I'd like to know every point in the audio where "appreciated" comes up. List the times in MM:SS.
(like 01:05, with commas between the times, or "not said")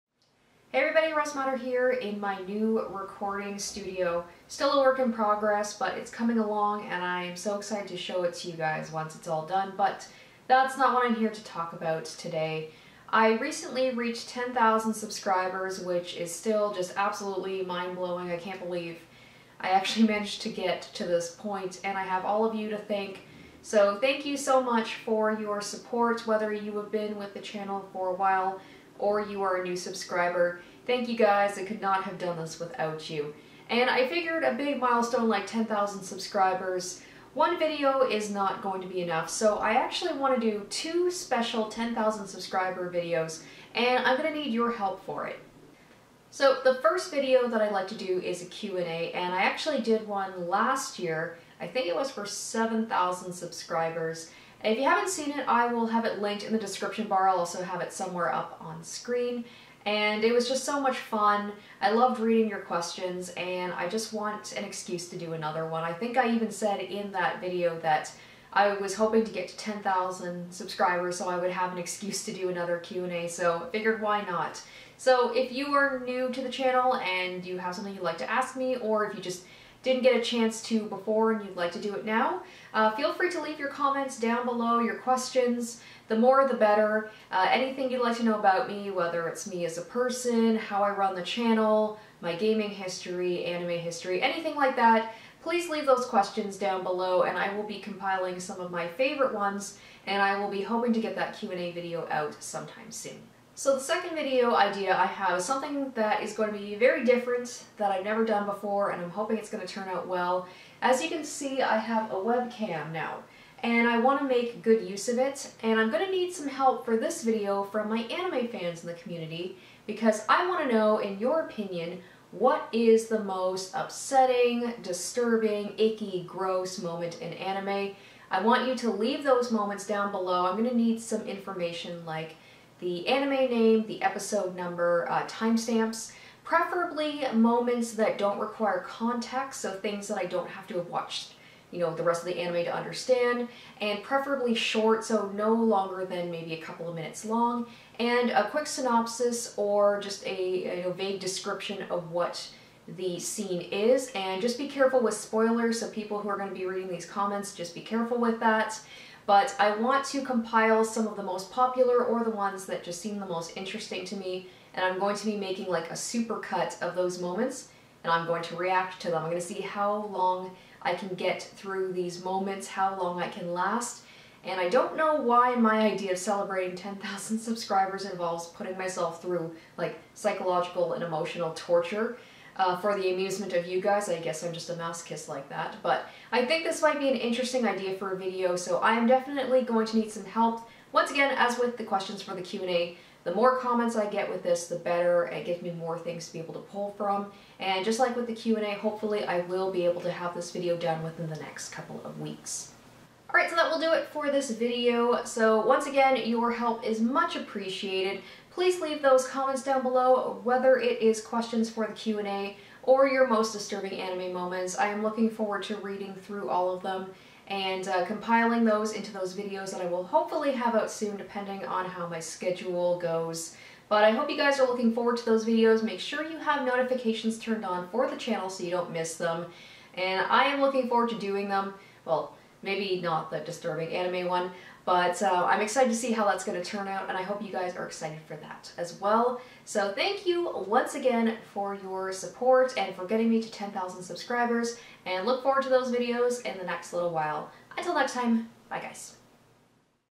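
03:27.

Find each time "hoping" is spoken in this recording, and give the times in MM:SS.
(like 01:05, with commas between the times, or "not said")
01:08, 01:40, 01:49.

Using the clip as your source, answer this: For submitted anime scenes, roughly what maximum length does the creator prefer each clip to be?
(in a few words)
a couple of minutes.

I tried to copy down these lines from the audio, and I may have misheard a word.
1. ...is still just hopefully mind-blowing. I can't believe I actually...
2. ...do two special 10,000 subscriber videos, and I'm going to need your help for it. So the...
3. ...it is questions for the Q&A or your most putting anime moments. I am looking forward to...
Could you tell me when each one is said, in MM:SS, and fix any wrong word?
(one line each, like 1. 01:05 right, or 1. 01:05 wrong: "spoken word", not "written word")
1. 00:16 wrong: "absolutely", not "hopefully"
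2. 00:40 right
3. 03:30 wrong: "disturbing", not "putting".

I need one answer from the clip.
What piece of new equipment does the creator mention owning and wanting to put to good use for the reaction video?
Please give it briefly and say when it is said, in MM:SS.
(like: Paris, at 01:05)
webcam, at 01:52.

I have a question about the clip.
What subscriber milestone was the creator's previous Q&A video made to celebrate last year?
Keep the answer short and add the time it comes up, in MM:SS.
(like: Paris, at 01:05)
7,000, at 00:52.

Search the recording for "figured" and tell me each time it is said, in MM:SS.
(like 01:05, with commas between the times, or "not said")
00:34, 01:13.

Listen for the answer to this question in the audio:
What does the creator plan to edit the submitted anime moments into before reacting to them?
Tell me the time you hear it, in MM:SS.
02:45.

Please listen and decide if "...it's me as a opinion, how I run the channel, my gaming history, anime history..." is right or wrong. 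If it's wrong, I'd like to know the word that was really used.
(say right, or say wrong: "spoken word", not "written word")
wrong: "person", not "opinion".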